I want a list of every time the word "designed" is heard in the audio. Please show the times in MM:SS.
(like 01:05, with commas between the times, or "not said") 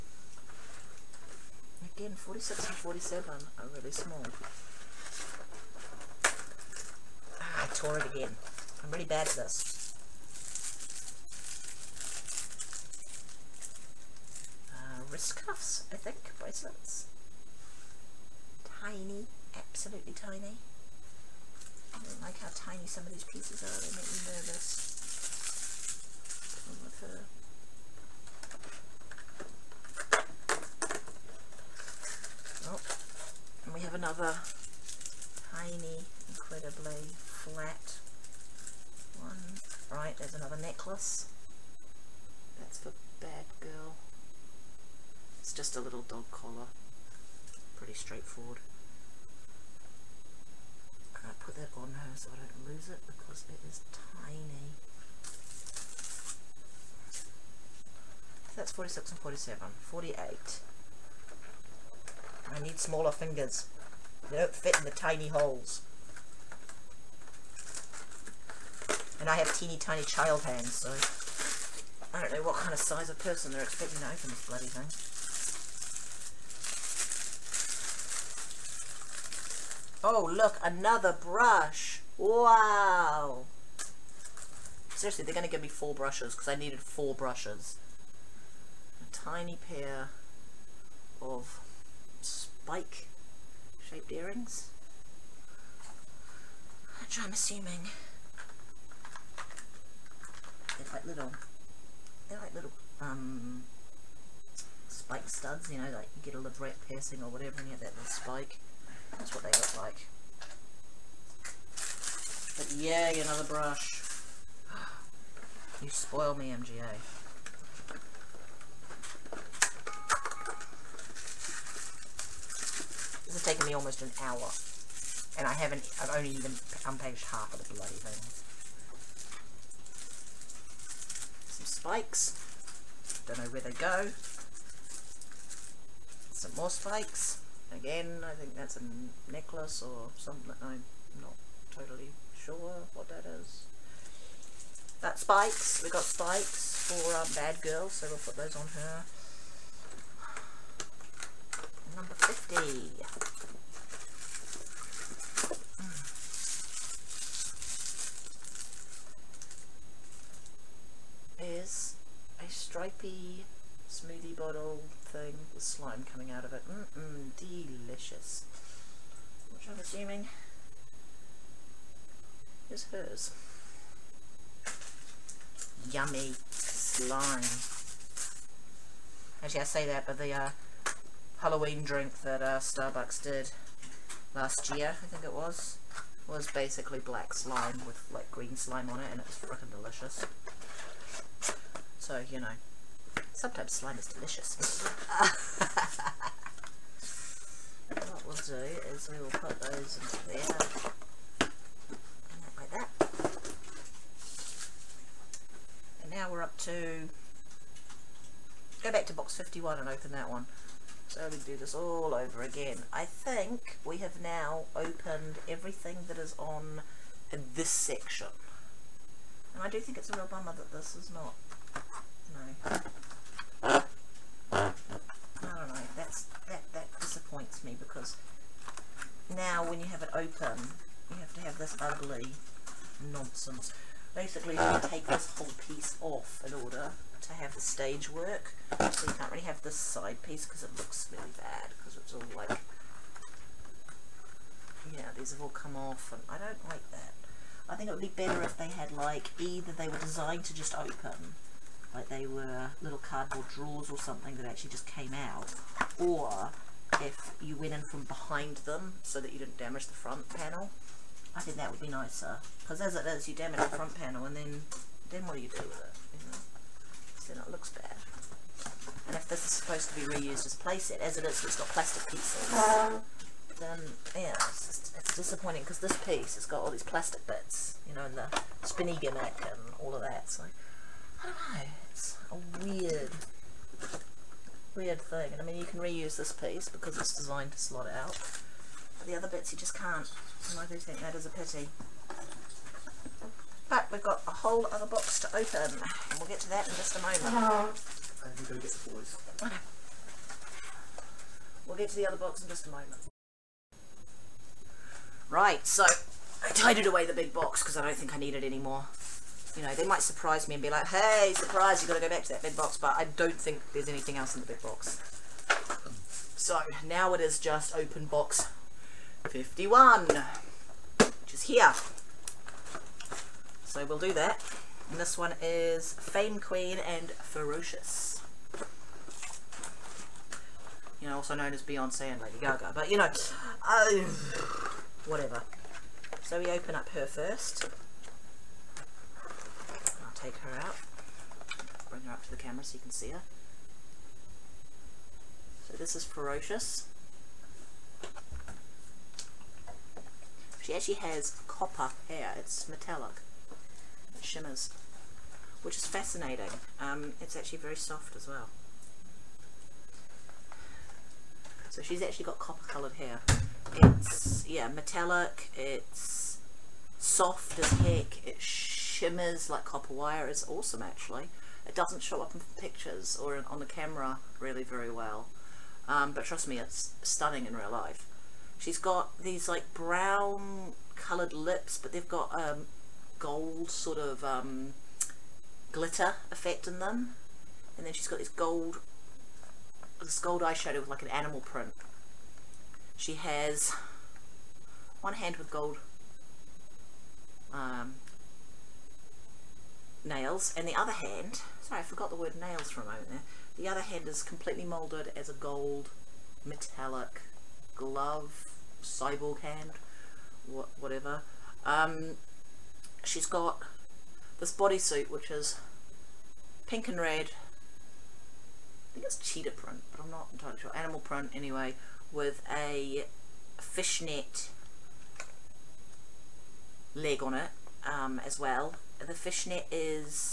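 04:09, 04:47.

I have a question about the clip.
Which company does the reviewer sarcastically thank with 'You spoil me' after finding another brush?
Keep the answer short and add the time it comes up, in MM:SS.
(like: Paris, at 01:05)
MGA, at 01:56.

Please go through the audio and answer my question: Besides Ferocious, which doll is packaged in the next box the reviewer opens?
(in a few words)
Fame Queen.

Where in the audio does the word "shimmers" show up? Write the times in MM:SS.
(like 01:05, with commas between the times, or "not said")
05:54, 06:08.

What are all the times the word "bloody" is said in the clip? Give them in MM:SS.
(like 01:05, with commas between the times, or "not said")
01:14, 02:07.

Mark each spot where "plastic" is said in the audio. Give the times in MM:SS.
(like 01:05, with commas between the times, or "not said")
04:31, 04:36.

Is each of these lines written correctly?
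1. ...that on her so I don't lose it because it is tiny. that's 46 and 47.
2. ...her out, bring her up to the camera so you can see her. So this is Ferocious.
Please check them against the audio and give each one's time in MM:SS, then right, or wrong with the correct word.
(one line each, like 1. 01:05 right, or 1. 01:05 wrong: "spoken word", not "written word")
1. 00:51 right
2. 05:40 right.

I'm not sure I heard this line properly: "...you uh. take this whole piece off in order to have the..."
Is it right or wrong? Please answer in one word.
right.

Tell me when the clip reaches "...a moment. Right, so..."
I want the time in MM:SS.
05:02.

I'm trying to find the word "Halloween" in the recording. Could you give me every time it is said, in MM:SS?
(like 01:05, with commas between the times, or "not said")
03:01.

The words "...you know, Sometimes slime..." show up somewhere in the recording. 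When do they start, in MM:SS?
03:12.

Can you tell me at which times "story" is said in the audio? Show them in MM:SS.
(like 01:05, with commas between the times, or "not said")
not said.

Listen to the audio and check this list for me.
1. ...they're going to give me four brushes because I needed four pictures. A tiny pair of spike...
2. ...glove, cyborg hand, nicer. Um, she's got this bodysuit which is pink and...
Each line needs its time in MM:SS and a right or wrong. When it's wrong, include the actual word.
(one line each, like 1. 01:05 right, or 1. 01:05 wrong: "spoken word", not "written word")
1. 01:25 wrong: "brushes", not "pictures"
2. 06:47 wrong: "whatever", not "nicer".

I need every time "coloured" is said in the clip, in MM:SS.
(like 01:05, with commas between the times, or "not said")
06:02, 06:20.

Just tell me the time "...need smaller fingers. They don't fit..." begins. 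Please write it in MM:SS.
01:02.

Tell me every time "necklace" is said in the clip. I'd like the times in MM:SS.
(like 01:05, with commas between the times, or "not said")
00:40, 02:19.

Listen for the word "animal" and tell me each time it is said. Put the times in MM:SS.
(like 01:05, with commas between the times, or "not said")
06:31, 07:00.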